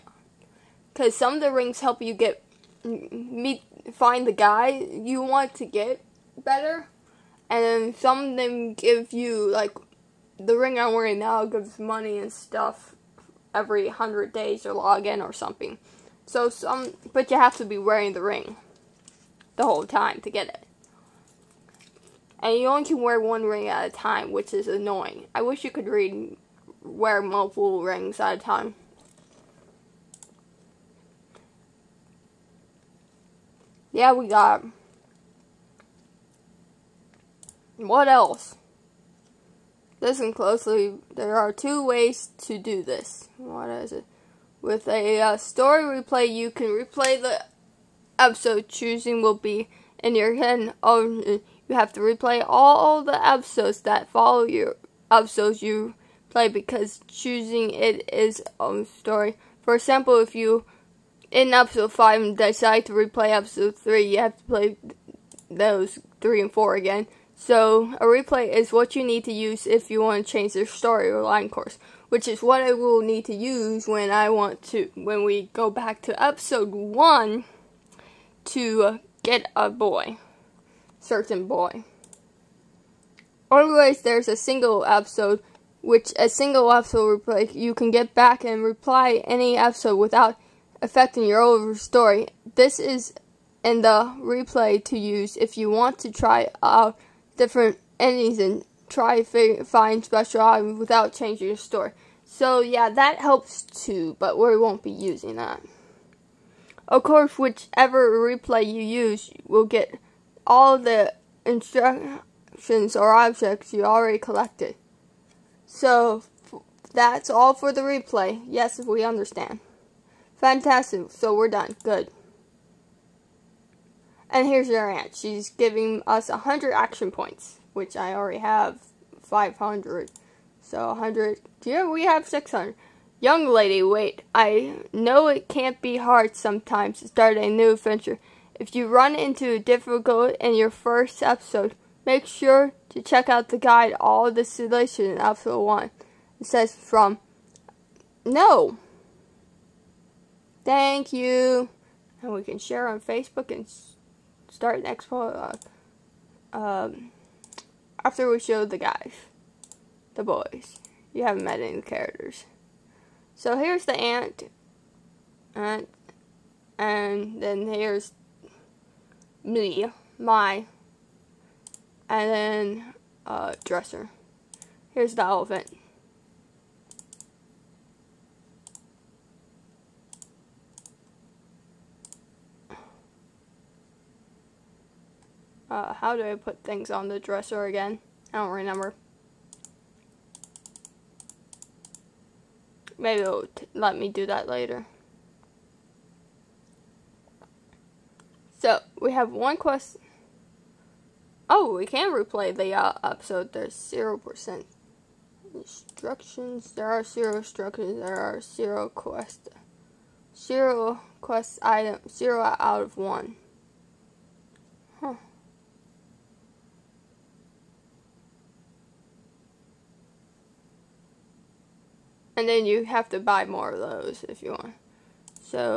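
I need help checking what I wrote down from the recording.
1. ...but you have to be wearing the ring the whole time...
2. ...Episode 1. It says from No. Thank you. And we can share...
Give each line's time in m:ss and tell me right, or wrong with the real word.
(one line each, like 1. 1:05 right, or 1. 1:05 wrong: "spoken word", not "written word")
1. 0:17 right
2. 2:25 right.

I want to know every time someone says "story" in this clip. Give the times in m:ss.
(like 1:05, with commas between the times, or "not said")
0:45, 0:58, 1:10, 1:31, 1:41.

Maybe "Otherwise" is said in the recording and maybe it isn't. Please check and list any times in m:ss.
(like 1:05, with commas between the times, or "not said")
1:23.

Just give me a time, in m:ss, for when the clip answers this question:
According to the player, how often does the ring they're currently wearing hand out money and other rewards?
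0:13.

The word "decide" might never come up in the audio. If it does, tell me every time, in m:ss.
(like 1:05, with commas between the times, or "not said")
1:02.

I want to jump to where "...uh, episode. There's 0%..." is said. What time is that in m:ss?
3:22.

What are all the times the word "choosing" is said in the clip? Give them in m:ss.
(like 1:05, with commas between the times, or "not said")
0:48, 0:57.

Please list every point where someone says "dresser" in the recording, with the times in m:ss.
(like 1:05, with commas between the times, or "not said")
2:53, 3:07.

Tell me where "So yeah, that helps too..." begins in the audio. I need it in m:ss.
1:42.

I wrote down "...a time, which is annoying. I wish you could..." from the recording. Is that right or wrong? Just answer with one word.
right.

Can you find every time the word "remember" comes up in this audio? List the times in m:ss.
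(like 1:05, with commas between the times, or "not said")
3:08.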